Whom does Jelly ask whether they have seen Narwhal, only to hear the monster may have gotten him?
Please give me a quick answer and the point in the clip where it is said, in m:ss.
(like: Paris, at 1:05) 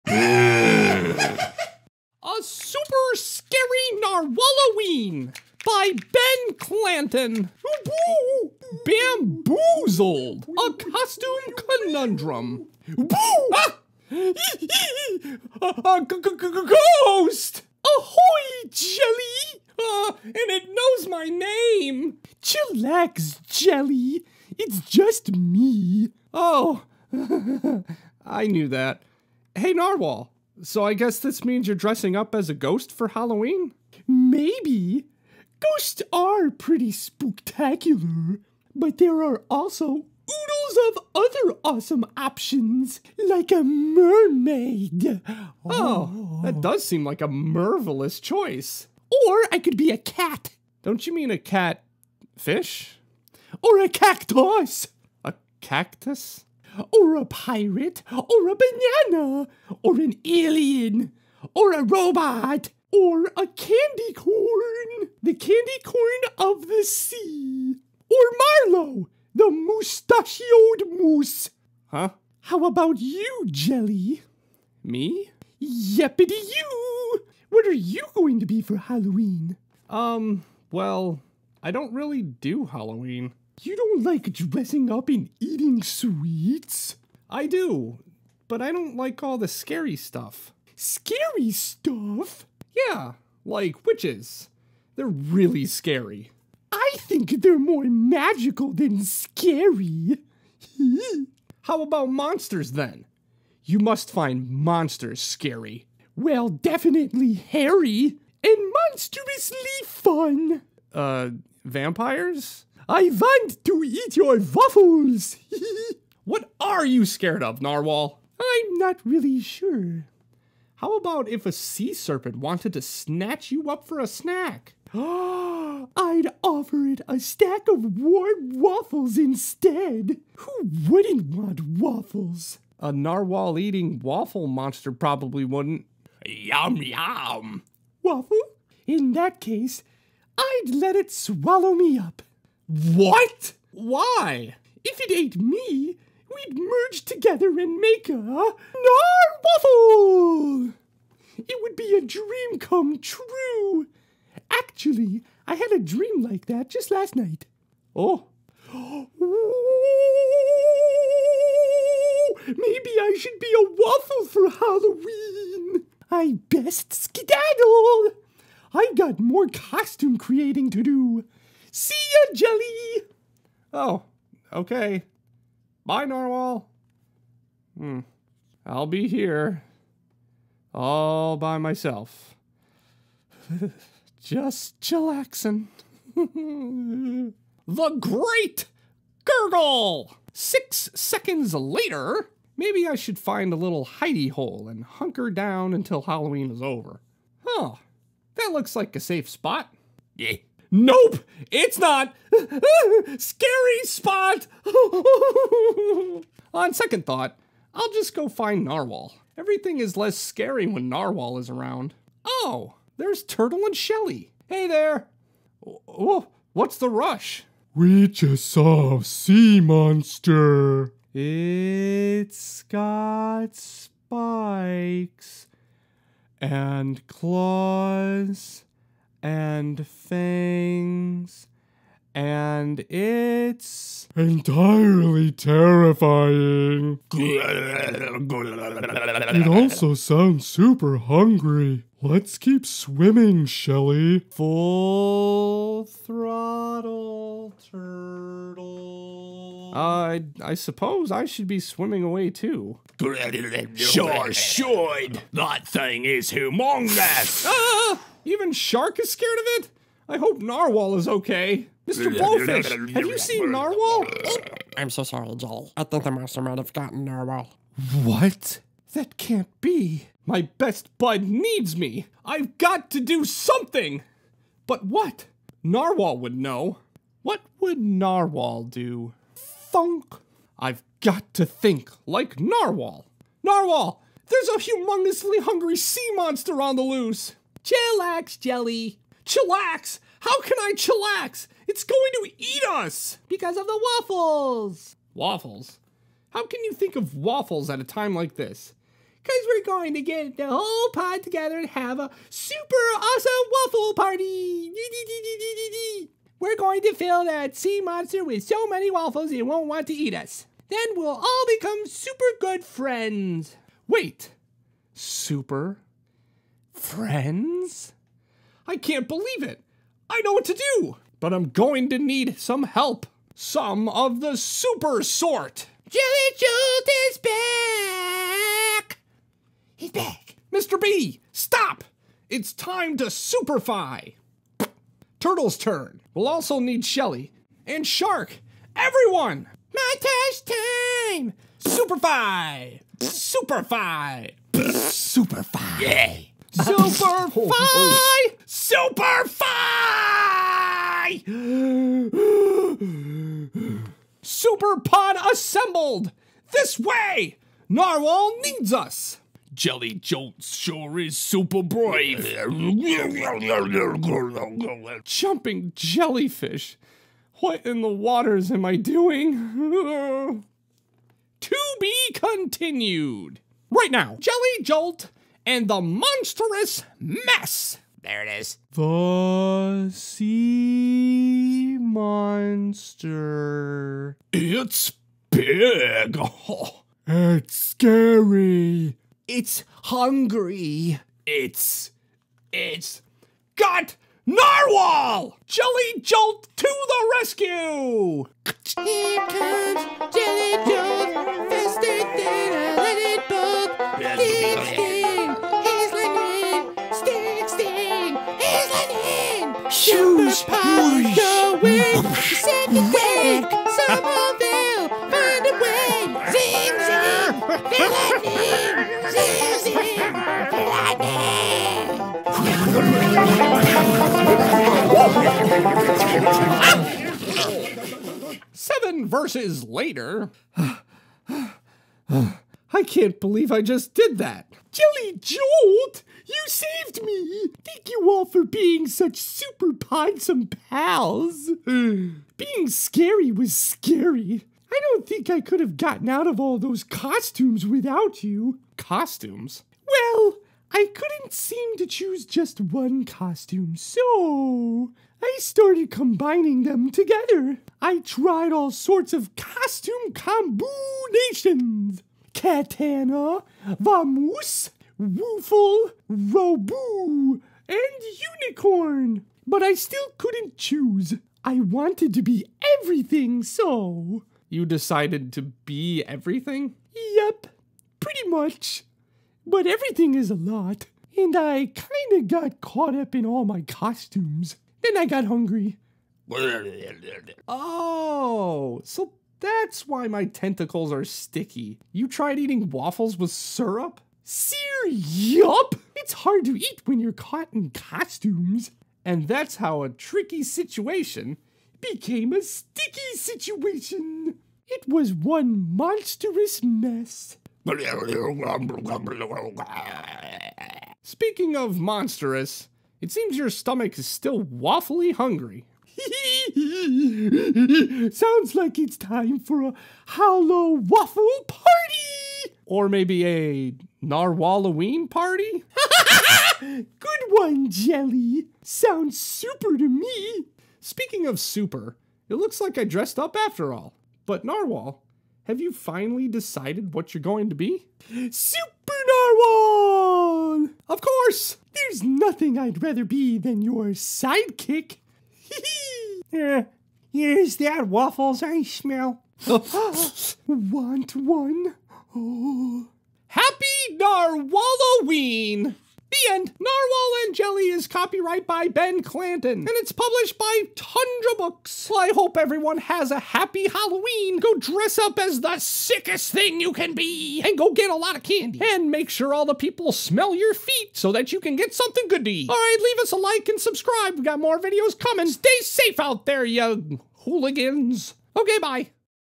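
Mr. Blowfish, at 4:21.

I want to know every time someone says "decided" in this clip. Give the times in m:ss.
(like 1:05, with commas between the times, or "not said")
7:54, 8:56.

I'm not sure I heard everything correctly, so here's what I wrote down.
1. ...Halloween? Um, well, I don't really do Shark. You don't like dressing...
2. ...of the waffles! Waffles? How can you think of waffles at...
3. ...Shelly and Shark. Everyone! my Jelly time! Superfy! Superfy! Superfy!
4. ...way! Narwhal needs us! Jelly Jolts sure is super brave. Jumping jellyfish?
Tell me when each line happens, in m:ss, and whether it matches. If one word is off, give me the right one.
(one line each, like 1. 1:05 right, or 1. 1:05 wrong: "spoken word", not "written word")
1. 1:18 wrong: "Halloween", not "Shark"
2. 4:53 right
3. 5:36 wrong: "Montage", not "Jelly"
4. 5:56 right.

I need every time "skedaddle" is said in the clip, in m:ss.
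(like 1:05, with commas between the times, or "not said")
2:46.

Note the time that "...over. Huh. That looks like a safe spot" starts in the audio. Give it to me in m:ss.
3:16.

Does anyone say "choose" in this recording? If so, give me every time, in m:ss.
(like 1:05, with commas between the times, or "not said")
7:31, 7:50.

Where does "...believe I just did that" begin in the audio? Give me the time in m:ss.
7:13.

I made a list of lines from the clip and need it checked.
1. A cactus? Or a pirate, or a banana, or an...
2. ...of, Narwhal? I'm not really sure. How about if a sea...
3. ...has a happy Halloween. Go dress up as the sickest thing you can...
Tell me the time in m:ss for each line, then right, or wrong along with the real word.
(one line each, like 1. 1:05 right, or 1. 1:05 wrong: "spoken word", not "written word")
1. 0:55 right
2. 1:57 right
3. 9:22 right.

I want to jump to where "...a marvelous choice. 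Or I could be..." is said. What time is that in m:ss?
0:47.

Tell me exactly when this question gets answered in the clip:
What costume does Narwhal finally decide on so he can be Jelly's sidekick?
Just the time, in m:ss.
8:58.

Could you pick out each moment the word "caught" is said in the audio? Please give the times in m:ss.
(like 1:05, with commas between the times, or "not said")
8:02, 8:17.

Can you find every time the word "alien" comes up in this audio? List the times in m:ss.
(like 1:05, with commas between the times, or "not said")
1:00.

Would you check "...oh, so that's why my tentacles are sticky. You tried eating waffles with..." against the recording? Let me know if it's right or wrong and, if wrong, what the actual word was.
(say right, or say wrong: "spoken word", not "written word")
right.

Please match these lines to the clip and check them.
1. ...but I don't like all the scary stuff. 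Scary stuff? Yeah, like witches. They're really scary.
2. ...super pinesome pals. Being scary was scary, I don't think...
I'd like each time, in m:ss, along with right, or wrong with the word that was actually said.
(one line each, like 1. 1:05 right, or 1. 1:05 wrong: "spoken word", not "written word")
1. 1:28 right
2. 7:19 right.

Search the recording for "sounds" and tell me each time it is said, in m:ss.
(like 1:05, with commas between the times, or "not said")
3:59, 8:38, 8:48.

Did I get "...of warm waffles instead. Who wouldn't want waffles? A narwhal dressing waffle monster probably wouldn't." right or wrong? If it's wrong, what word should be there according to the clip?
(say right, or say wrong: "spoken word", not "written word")
wrong: "eating", not "dressing".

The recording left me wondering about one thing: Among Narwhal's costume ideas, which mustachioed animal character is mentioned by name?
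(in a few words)
Marlowe.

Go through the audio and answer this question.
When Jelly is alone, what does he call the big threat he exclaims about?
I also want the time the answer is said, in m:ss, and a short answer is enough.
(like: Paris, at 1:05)
The Great Gurgle, at 3:07.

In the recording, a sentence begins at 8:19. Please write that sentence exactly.
And that's how a tricky situation became a sticky situation.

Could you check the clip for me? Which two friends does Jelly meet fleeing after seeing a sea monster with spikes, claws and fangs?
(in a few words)
Turtle and Shelly.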